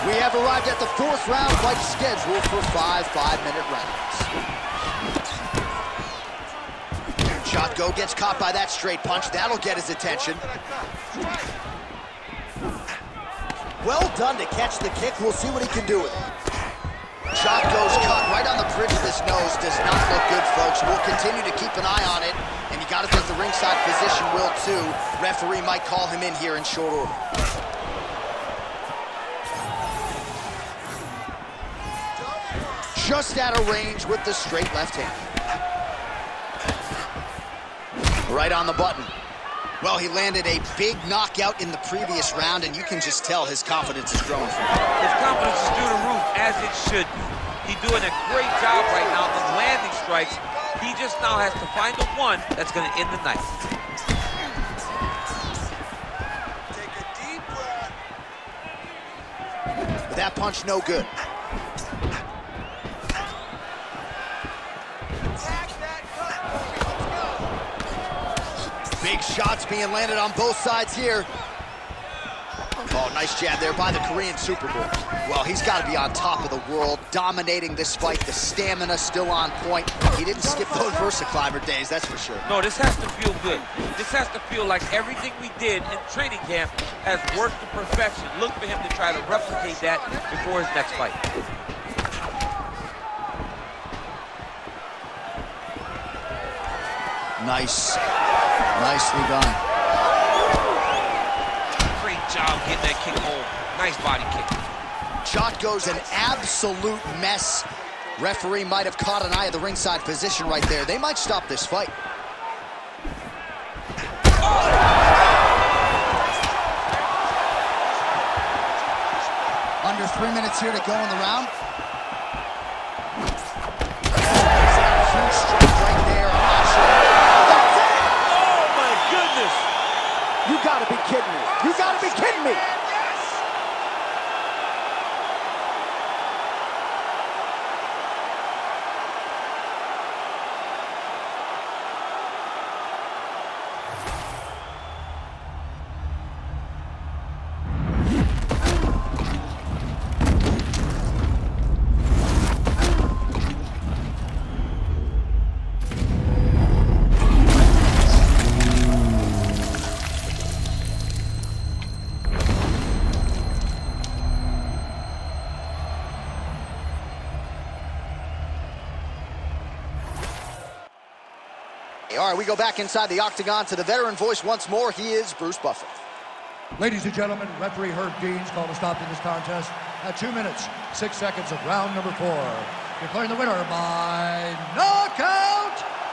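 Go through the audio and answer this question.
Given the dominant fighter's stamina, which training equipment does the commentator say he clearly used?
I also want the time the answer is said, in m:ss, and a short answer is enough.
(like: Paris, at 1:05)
VersaClimber, at 1:21.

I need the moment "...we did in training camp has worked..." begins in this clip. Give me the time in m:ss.
1:25.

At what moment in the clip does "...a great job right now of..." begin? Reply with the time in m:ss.
0:48.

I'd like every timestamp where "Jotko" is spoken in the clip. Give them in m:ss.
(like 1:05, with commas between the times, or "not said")
0:07, 1:45.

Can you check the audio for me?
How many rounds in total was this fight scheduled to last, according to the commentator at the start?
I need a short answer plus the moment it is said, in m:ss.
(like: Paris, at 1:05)
5, at 0:02.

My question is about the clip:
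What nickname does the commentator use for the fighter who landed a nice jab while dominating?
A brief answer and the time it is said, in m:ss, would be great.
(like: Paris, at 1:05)
Korean Superboy, at 1:14.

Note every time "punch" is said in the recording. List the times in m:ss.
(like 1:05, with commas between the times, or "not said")
0:09, 1:00.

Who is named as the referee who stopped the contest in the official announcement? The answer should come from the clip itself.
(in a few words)
Herb Dean.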